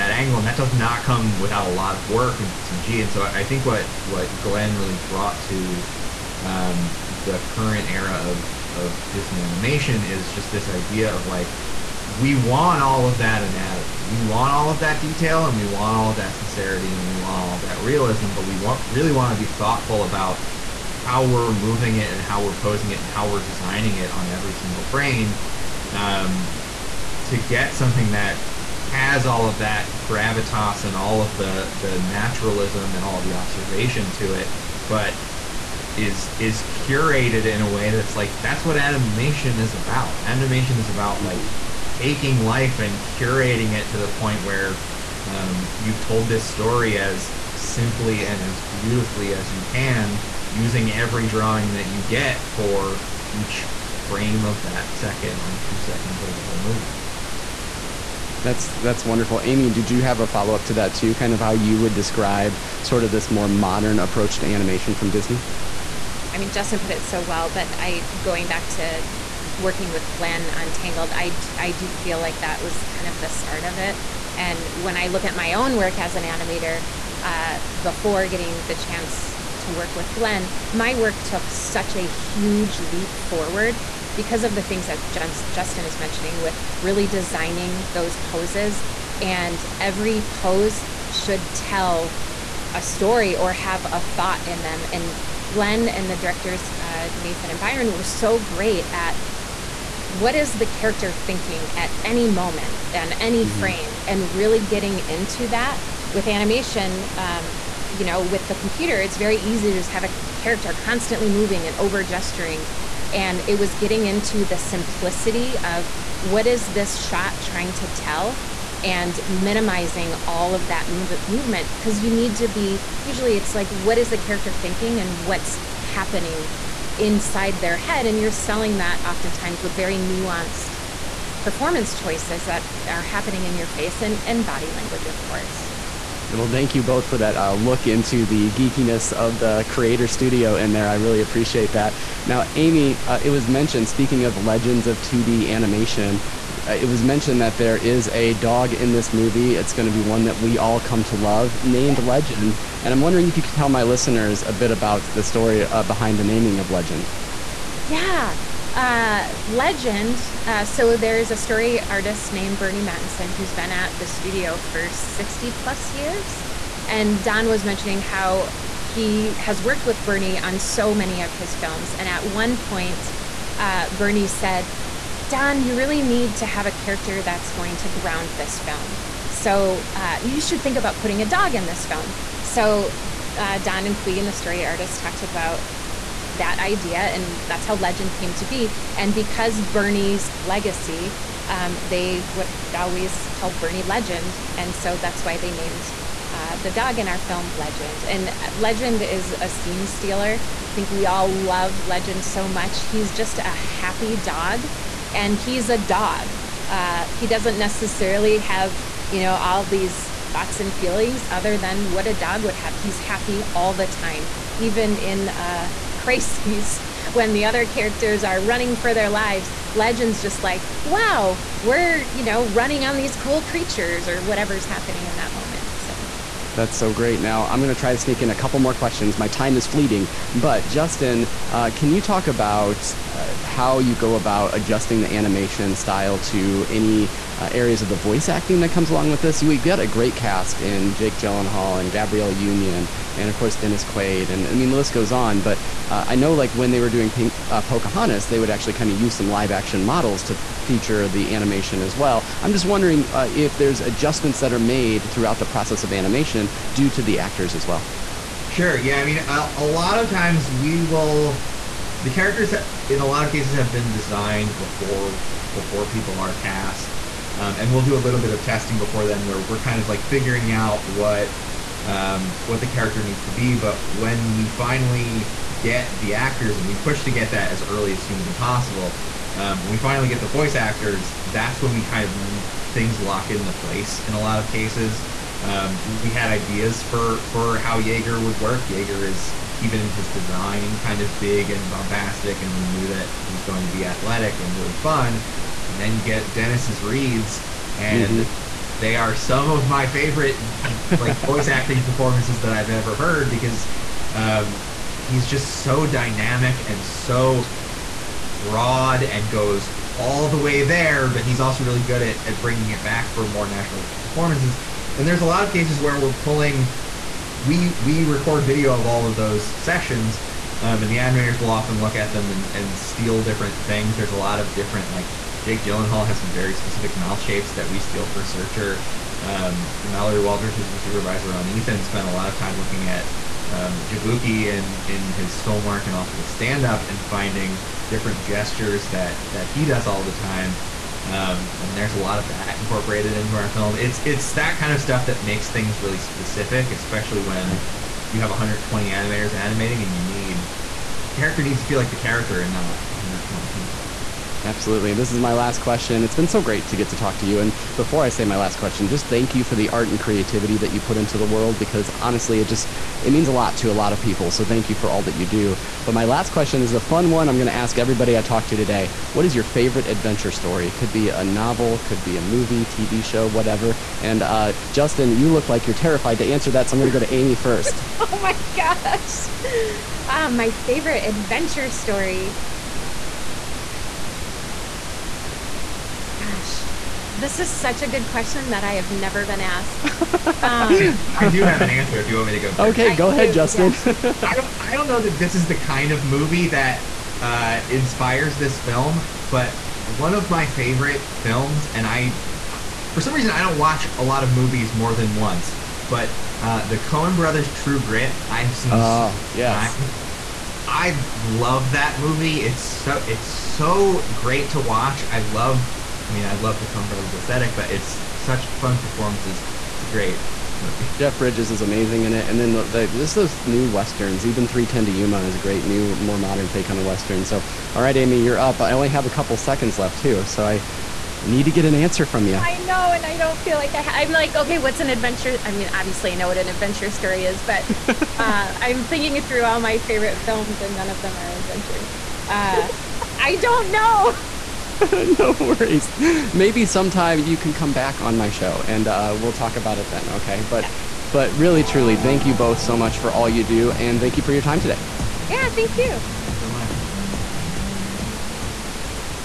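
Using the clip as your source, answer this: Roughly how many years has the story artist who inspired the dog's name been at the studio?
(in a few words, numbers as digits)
60 plus years.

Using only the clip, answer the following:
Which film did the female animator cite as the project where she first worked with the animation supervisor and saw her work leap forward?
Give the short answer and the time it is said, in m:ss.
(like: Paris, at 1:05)
Tangled, at 1:10.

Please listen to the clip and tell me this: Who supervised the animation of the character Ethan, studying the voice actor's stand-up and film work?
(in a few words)
Mallory Walters.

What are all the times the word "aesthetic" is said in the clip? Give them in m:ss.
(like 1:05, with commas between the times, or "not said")
6:57.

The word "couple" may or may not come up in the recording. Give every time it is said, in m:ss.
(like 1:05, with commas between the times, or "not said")
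3:48, 7:09.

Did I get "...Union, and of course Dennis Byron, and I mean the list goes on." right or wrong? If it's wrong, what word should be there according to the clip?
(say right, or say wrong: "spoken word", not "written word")
wrong: "Quaid", not "Byron".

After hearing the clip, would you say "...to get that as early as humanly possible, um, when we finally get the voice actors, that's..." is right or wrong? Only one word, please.
right.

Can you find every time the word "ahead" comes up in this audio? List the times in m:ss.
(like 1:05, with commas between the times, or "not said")
6:33.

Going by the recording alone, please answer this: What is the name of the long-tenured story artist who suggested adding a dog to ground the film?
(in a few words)
Burny Mattinson.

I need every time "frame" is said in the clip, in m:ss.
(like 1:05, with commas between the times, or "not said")
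0:24, 0:54, 1:43.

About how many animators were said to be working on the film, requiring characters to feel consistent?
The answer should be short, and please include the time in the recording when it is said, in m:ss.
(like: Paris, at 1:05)
120, at 5:48.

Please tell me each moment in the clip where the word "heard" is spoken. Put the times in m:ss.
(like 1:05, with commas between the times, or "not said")
5:02.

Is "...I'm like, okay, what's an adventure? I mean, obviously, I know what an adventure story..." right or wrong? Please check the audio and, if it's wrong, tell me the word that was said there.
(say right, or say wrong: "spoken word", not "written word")
right.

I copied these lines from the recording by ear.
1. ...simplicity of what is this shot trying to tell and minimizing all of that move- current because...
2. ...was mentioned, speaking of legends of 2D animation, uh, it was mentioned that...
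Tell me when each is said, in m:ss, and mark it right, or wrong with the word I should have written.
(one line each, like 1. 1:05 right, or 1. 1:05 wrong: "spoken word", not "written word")
1. 1:54 wrong: "movement", not "current"
2. 2:23 right.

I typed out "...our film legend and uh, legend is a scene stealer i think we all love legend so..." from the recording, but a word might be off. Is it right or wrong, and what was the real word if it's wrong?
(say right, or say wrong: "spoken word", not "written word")
right.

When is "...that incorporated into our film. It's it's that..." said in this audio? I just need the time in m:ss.
5:42.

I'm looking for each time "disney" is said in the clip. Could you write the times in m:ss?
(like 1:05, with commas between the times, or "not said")
0:09, 1:05.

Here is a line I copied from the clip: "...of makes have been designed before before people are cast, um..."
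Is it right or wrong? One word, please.
wrong.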